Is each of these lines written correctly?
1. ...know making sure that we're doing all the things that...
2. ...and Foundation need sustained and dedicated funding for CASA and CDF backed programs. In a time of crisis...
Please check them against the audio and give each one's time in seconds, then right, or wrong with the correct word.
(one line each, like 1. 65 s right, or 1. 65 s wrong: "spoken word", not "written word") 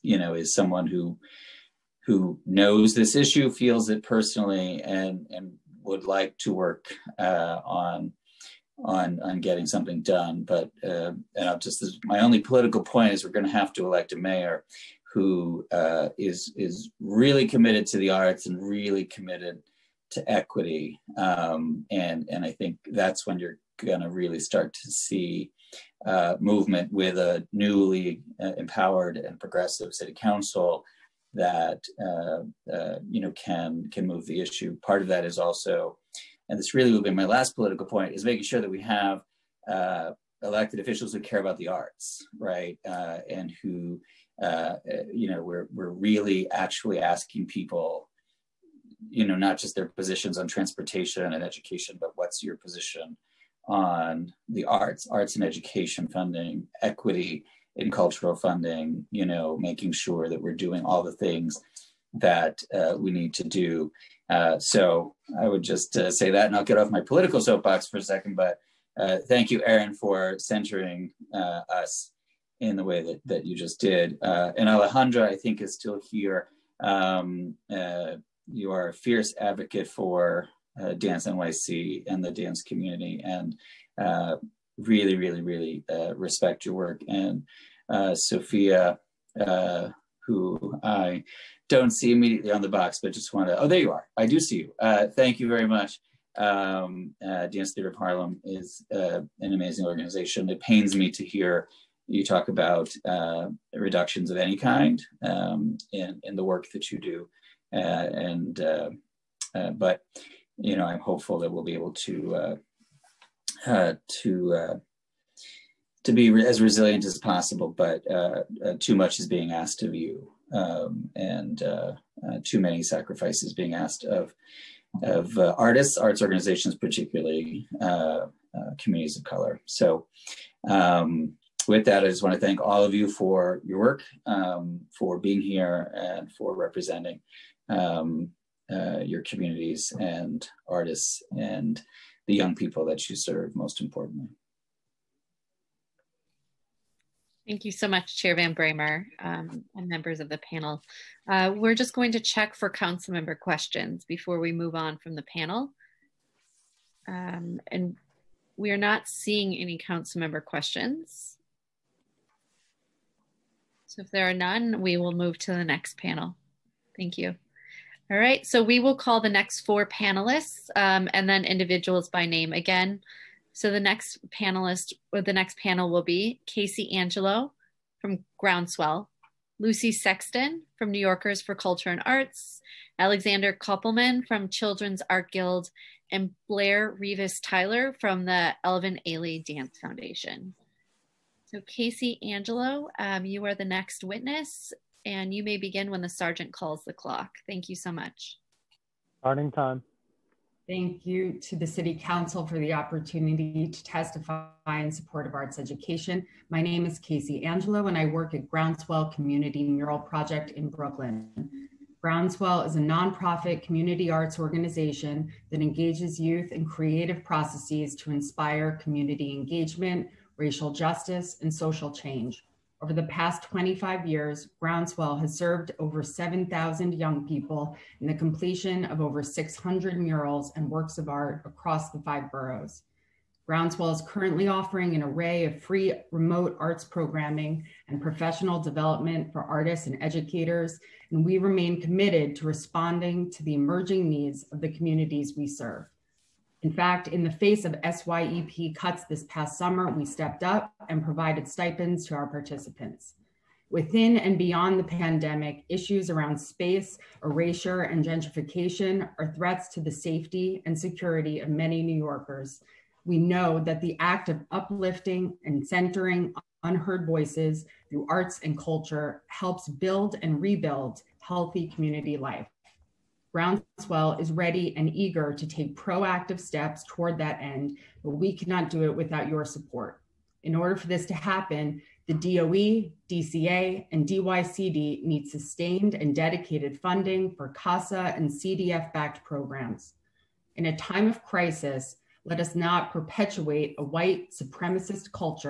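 1. 59 s right
2. 283 s wrong: "DYCD", not "Foundation".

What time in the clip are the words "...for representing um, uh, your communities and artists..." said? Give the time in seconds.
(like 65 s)
136 s.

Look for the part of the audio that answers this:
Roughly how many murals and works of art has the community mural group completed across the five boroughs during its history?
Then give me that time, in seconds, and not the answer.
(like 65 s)
229 s.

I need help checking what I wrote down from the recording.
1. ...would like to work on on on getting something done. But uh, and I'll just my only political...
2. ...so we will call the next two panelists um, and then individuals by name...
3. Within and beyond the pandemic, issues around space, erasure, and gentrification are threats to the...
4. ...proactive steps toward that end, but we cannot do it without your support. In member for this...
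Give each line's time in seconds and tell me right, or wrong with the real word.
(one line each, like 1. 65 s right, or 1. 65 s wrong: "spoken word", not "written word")
1. 5 s right
2. 168 s wrong: "four", not "two"
3. 253 s right
4. 275 s wrong: "order", not "member".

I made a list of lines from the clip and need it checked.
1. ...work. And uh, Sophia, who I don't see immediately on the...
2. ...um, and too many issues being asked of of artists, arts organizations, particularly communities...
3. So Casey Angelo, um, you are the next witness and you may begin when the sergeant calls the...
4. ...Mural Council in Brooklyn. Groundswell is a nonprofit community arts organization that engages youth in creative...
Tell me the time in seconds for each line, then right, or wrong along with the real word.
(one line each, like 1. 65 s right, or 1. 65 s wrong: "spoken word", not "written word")
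1. 86 s right
2. 120 s wrong: "sacrifices", not "issues"
3. 191 s right
4. 209 s wrong: "Project", not "Council".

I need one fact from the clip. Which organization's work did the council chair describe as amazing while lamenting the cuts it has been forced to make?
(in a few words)
Dance Theater of Harlem.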